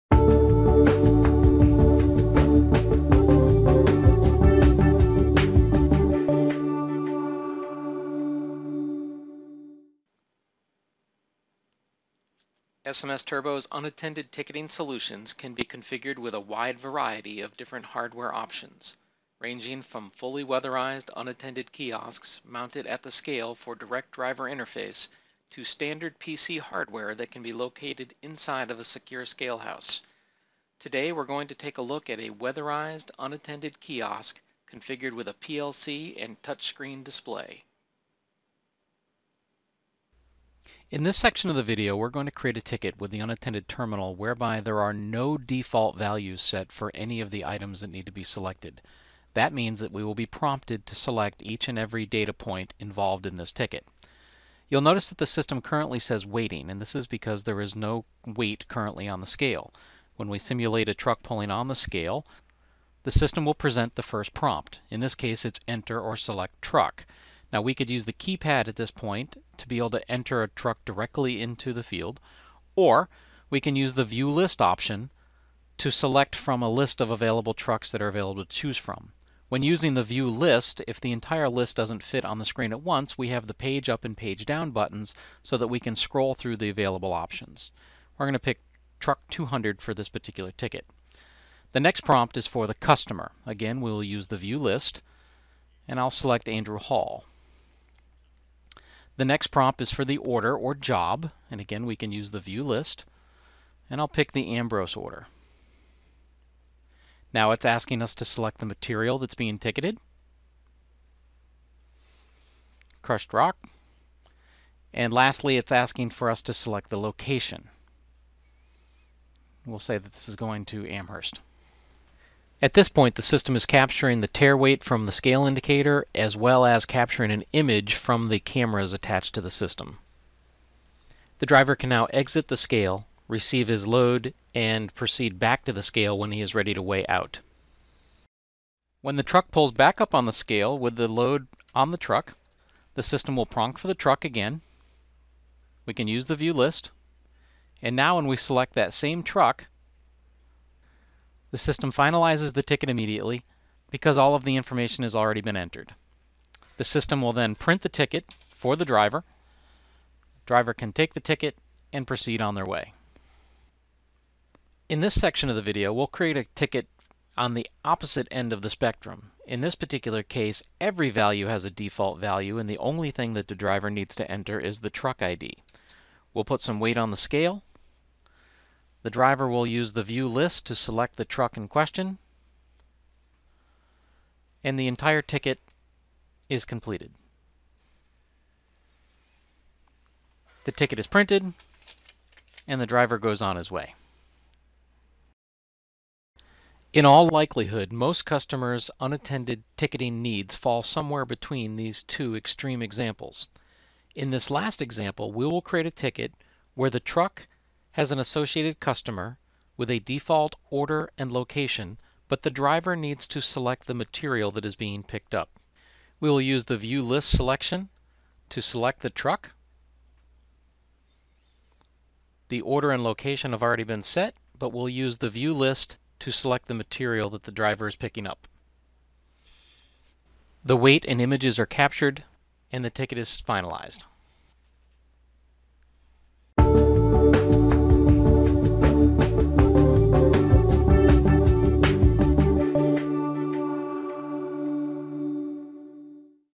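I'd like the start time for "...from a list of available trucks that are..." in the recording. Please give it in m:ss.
1:16.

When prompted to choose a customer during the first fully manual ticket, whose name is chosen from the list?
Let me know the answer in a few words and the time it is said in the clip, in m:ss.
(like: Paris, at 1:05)
Andrew Hall, at 1:36.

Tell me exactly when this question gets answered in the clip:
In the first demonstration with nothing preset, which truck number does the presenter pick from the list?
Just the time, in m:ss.
1:29.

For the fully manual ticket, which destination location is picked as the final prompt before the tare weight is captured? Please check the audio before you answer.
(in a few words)
Amherst.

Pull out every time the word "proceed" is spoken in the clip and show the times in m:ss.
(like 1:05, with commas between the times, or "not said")
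2:14, 2:42.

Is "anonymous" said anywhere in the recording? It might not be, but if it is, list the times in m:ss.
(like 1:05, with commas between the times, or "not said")
not said.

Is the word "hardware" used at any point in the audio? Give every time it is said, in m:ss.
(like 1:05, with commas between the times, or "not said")
0:17, 0:26.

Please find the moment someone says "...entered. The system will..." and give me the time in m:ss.
2:35.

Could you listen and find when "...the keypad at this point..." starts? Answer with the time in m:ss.
1:08.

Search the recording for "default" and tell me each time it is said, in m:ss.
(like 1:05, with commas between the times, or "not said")
0:45, 2:51, 3:29.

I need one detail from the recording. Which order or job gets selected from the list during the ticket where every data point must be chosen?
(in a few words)
Ambrose.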